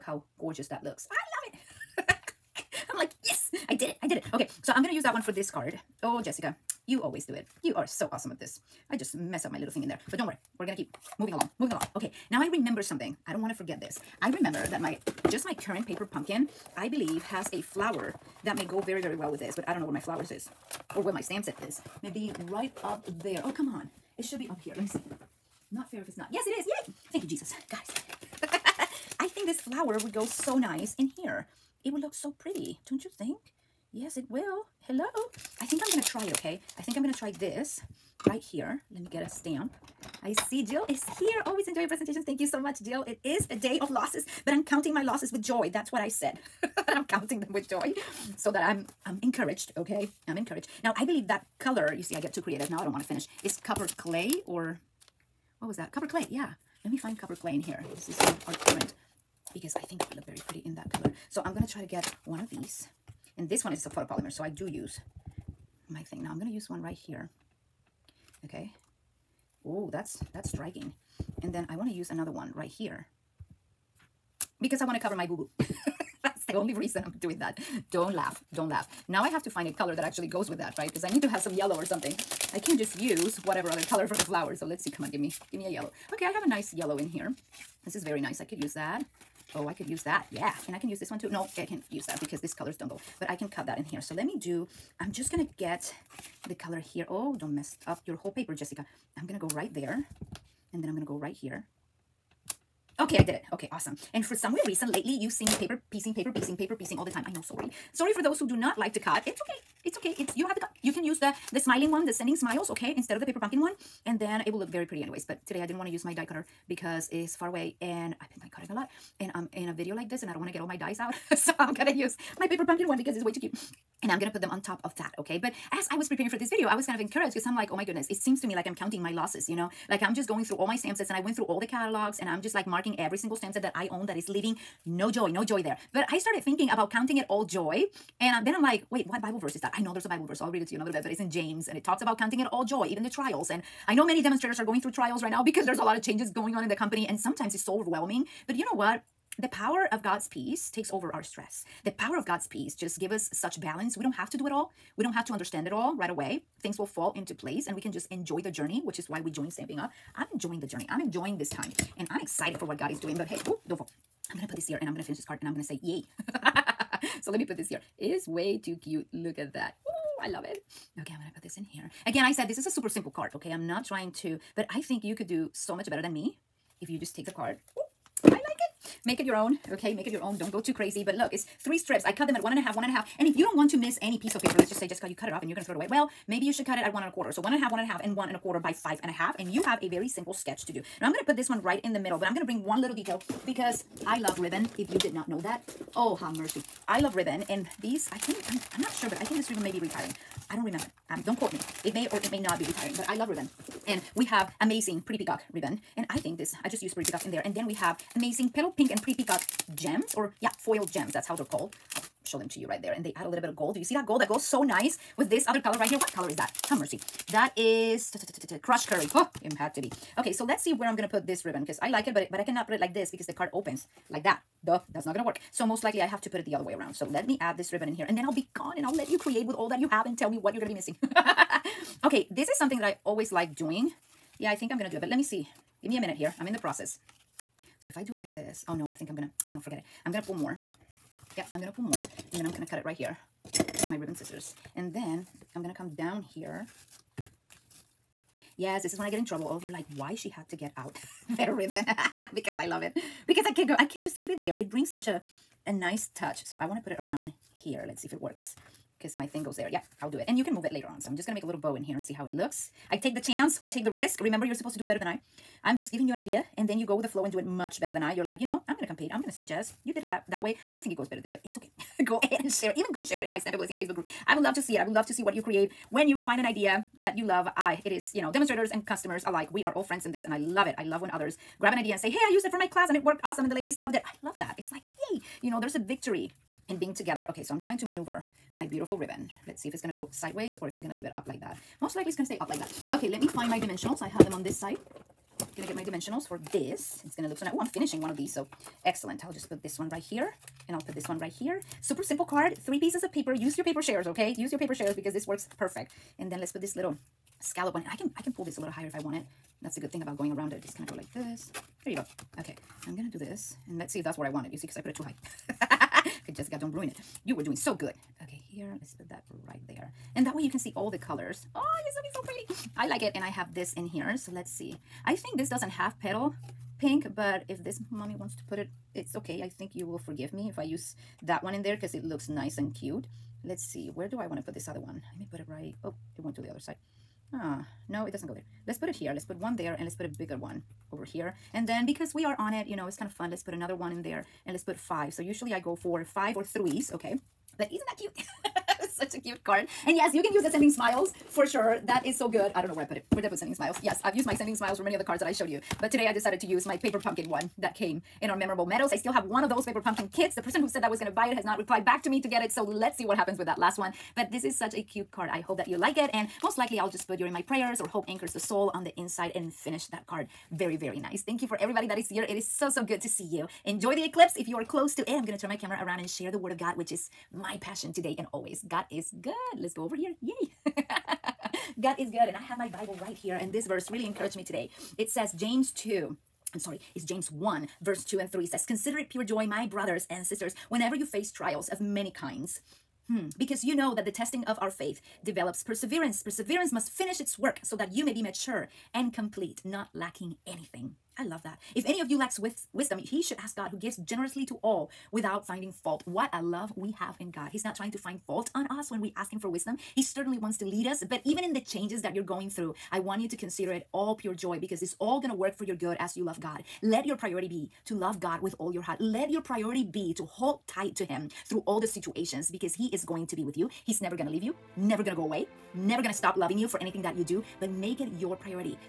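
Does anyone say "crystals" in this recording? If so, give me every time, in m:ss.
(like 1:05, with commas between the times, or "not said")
not said.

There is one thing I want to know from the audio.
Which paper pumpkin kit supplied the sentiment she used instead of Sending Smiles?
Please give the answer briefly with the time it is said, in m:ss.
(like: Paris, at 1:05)
Memorable Meadows, at 5:58.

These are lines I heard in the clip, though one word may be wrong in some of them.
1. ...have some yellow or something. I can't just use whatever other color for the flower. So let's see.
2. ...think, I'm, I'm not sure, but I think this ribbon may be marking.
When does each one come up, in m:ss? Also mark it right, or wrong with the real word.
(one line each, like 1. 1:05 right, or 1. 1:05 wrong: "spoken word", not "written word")
1. 1:21 right
2. 3:18 wrong: "retiring", not "marking".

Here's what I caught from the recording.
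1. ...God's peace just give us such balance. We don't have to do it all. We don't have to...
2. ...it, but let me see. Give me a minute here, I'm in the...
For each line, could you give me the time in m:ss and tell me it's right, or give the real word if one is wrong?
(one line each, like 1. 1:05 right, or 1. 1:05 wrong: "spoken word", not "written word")
1. 2:32 right
2. 3:54 right.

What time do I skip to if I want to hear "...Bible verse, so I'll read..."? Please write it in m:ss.
2:20.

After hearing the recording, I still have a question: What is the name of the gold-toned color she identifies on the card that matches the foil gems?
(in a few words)
Crushed Curry.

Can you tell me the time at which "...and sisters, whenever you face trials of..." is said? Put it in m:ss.
6:30.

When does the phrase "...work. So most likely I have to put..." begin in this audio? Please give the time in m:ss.
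3:45.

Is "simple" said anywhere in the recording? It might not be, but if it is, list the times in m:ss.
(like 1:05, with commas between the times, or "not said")
2:52, 3:10, 5:02.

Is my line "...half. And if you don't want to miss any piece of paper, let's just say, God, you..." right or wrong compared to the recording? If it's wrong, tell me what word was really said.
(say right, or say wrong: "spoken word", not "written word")
wrong: "Jessica", not "God".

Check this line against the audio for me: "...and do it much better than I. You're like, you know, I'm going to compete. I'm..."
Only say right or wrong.
right.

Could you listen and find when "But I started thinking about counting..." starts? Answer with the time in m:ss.
2:15.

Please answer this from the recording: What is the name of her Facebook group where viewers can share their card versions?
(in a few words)
Stamp Blessing.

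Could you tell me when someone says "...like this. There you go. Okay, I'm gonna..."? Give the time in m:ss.
5:10.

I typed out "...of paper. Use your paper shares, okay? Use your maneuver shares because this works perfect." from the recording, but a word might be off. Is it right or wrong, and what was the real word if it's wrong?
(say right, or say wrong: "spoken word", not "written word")
wrong: "paper", not "maneuver".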